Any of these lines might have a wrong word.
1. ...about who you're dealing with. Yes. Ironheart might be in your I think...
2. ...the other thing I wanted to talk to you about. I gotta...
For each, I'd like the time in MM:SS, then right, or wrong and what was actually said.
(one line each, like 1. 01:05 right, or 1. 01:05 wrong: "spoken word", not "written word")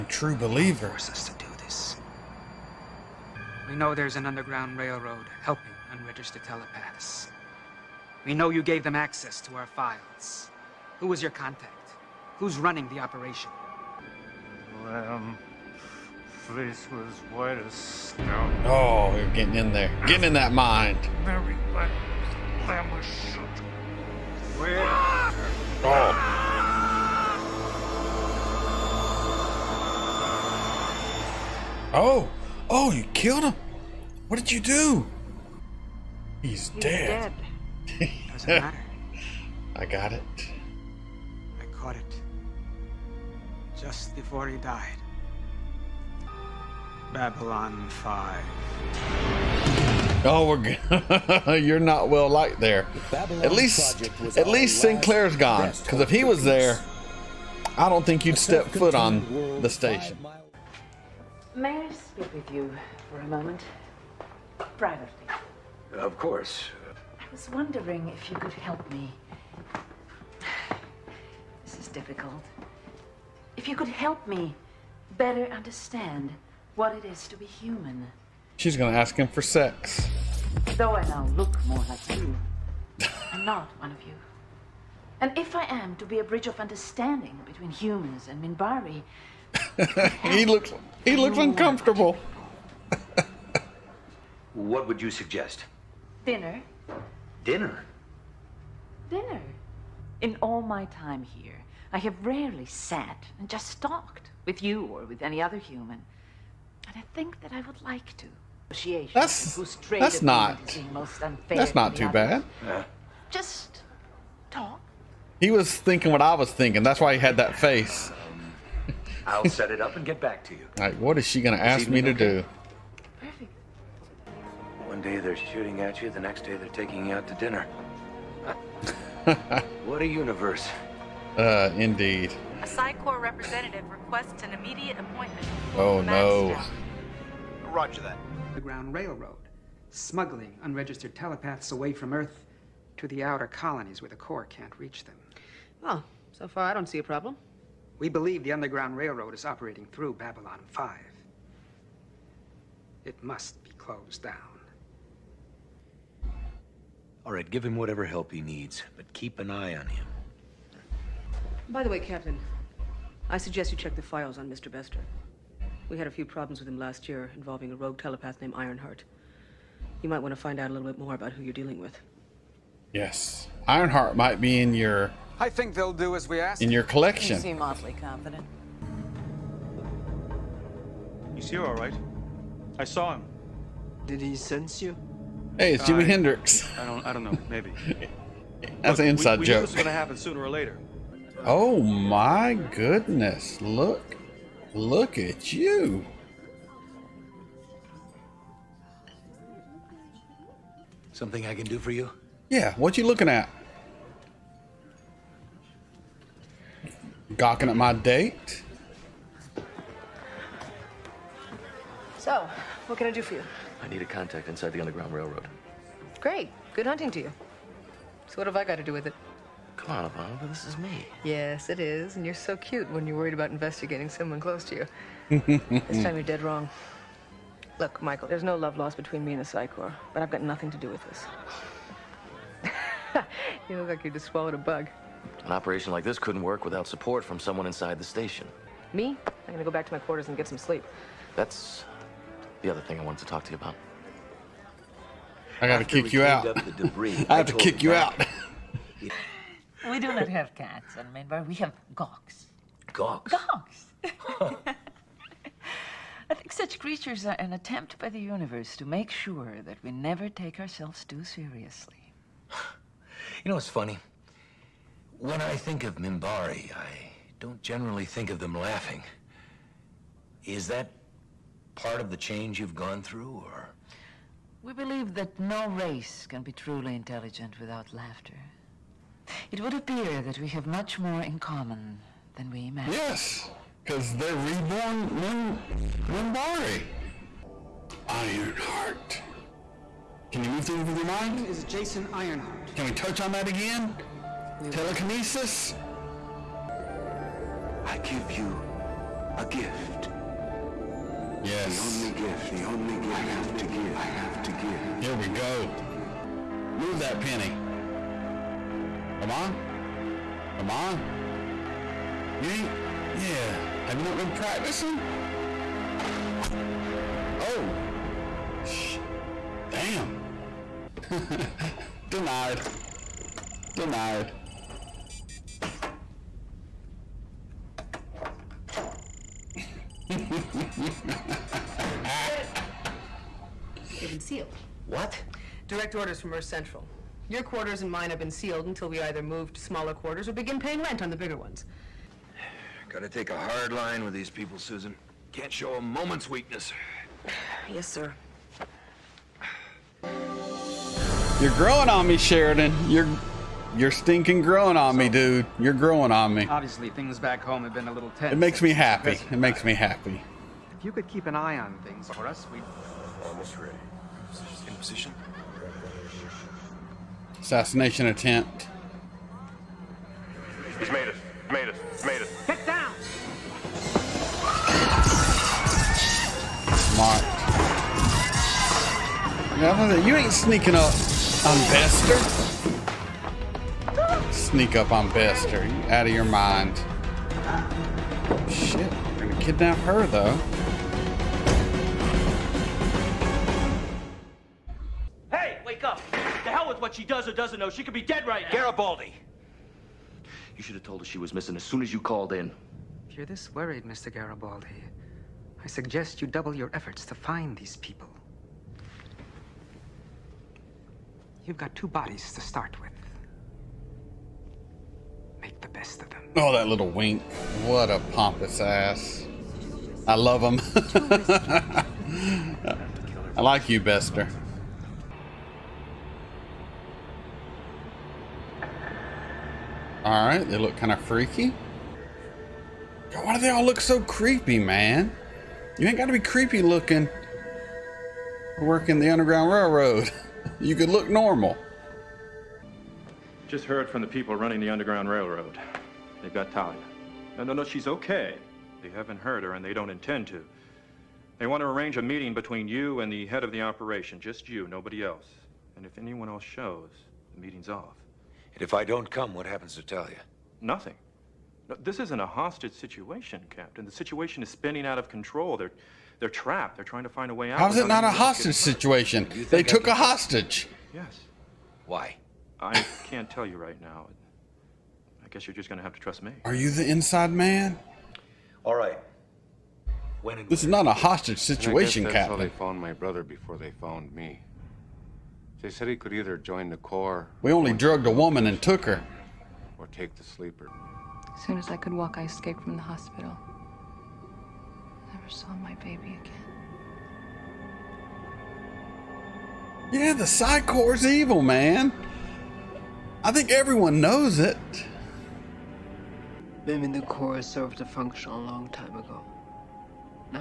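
1. 02:51 right
2. 04:02 right.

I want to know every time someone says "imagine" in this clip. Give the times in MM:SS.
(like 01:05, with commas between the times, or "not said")
04:42.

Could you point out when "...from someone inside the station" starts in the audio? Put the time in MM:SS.
03:57.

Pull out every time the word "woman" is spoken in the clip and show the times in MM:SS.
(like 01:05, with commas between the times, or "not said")
08:08.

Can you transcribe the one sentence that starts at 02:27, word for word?
We believe the Underground Railroad is operating through Babylon 5.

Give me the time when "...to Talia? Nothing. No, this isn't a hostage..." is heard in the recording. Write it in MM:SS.
07:39.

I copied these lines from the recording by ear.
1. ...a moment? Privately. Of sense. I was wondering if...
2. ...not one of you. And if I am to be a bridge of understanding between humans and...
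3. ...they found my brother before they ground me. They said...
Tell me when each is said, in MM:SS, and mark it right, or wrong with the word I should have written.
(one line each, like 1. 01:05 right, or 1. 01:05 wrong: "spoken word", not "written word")
1. 01:03 wrong: "course", not "sense"
2. 01:23 right
3. 08:02 wrong: "found", not "ground".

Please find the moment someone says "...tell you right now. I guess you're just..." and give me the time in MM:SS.
07:53.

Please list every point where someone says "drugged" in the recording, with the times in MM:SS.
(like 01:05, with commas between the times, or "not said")
08:07.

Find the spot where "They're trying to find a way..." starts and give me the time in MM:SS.
07:46.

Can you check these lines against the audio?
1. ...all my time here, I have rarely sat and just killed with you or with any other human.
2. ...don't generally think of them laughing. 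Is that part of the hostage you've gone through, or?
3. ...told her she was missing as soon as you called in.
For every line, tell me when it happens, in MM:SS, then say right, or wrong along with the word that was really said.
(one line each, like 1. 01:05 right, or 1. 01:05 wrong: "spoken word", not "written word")
1. 01:40 wrong: "talked", not "killed"
2. 04:27 wrong: "change", not "hostage"
3. 06:40 right.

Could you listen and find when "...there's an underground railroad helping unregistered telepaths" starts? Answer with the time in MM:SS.
00:03.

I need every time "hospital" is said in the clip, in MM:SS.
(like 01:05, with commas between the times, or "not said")
08:12.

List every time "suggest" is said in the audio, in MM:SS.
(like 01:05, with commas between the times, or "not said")
01:35, 02:43, 06:45.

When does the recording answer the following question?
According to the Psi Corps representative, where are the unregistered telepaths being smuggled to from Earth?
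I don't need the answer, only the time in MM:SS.
02:23.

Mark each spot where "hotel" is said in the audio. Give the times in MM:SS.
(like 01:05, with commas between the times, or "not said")
not said.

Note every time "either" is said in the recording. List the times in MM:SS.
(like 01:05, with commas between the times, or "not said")
05:39, 08:06.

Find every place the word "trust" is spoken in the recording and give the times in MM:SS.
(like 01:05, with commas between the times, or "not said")
07:55.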